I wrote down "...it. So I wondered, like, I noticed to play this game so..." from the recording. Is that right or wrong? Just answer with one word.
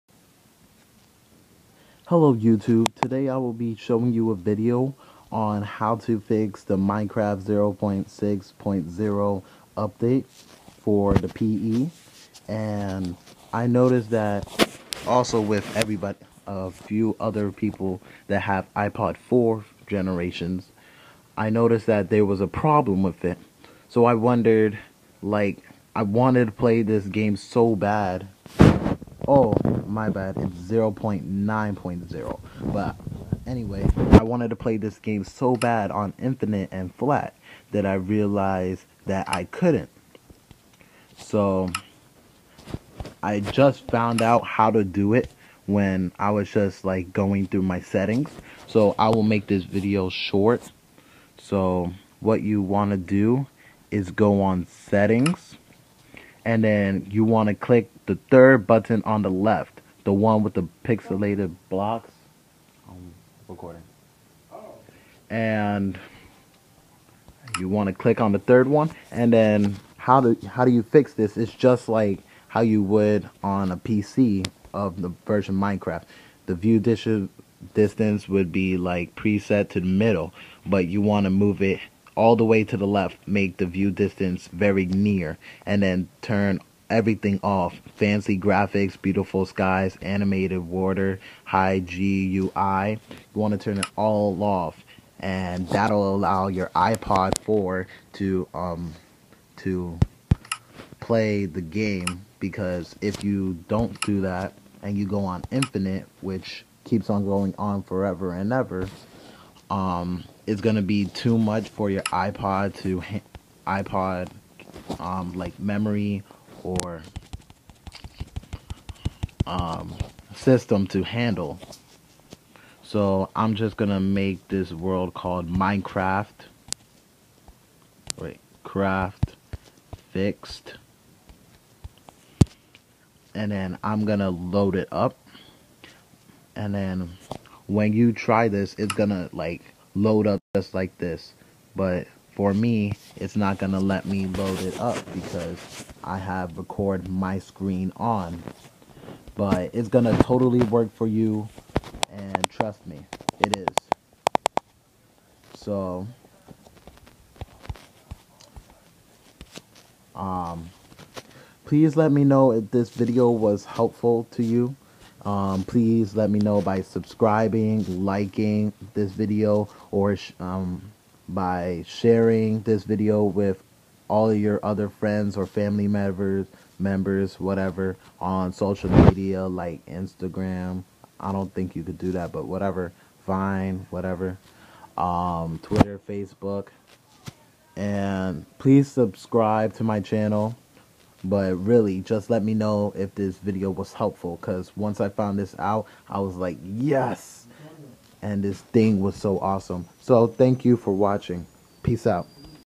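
wrong.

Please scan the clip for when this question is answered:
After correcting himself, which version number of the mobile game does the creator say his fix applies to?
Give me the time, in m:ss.
0:30.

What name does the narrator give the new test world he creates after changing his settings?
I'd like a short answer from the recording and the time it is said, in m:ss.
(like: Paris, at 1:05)
Craft Fixed, at 2:08.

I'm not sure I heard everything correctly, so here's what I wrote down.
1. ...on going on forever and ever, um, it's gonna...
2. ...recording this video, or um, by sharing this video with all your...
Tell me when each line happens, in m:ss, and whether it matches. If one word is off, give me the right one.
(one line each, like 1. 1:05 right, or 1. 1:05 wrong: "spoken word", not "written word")
1. 1:47 right
2. 2:48 wrong: "liking", not "recording".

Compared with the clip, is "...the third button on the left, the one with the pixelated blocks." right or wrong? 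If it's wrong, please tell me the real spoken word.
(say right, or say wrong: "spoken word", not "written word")
right.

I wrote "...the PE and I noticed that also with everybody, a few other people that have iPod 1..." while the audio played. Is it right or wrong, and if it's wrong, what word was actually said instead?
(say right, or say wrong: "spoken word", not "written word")
wrong: "4", not "1".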